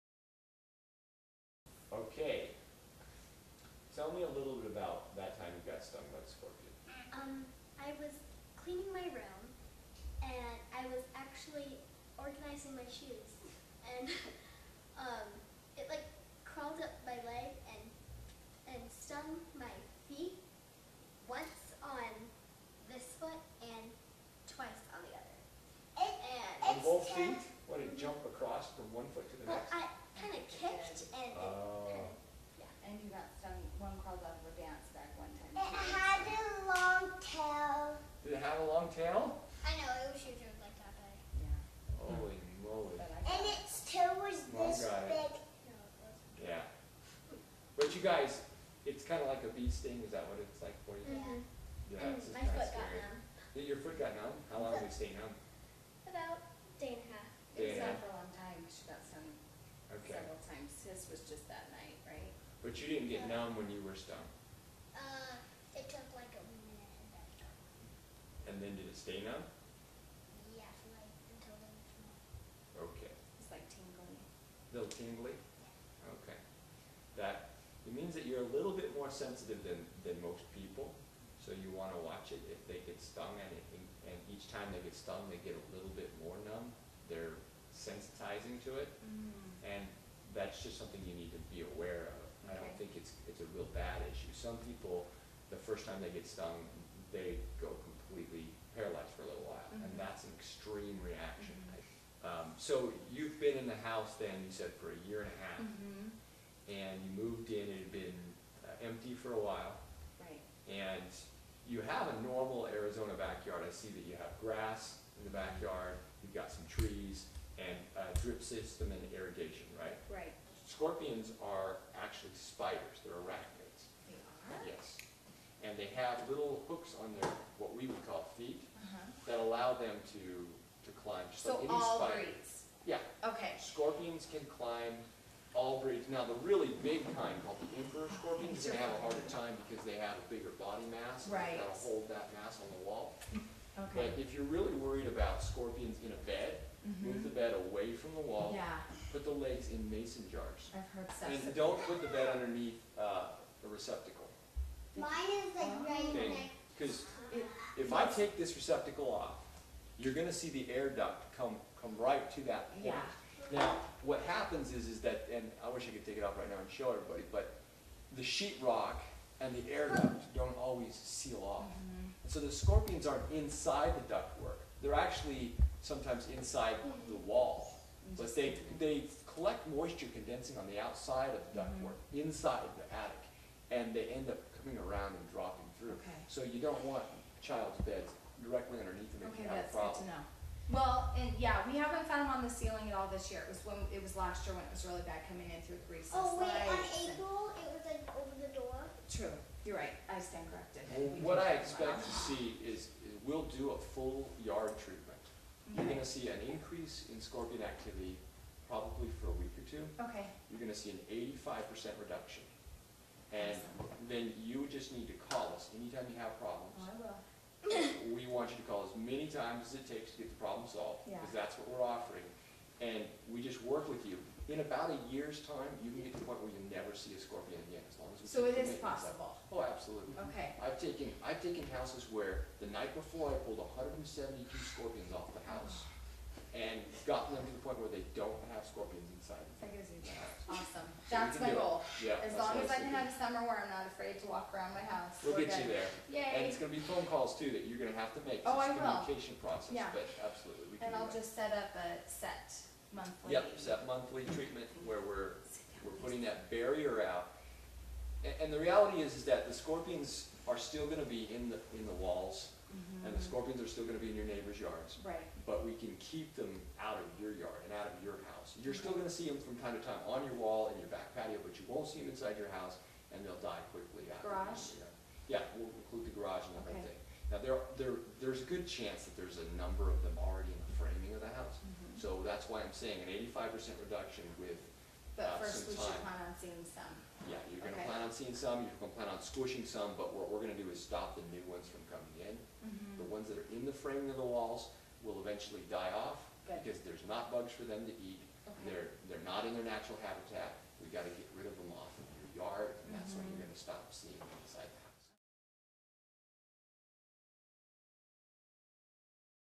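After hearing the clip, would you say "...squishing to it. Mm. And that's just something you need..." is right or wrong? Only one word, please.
wrong.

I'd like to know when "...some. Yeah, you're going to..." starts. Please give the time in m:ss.
4:46.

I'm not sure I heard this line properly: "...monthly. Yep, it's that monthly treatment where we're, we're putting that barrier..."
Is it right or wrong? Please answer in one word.
right.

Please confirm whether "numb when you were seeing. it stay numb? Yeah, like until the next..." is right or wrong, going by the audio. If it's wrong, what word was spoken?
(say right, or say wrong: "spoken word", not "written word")
wrong: "stung", not "seeing".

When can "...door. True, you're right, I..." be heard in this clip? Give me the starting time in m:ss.
3:18.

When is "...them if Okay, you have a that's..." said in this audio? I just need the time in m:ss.
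3:09.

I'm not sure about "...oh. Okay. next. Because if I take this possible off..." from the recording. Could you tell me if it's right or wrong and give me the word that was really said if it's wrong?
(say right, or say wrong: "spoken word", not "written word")
wrong: "receptacle", not "possible".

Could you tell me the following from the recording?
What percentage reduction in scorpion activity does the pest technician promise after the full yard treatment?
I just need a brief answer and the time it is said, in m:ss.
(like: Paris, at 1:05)
85%, at 3:31.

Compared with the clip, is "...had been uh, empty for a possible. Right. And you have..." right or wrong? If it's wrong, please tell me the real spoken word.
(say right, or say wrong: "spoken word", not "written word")
wrong: "while", not "possible".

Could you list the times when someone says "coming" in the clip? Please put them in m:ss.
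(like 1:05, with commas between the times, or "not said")
3:04, 3:15.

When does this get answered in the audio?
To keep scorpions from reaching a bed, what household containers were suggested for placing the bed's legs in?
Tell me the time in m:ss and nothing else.
2:29.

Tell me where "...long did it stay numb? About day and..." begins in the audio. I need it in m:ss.
0:54.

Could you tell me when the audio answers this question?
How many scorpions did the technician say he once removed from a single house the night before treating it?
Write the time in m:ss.
3:53.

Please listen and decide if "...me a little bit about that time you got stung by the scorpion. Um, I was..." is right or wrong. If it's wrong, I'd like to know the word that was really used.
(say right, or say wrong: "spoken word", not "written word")
right.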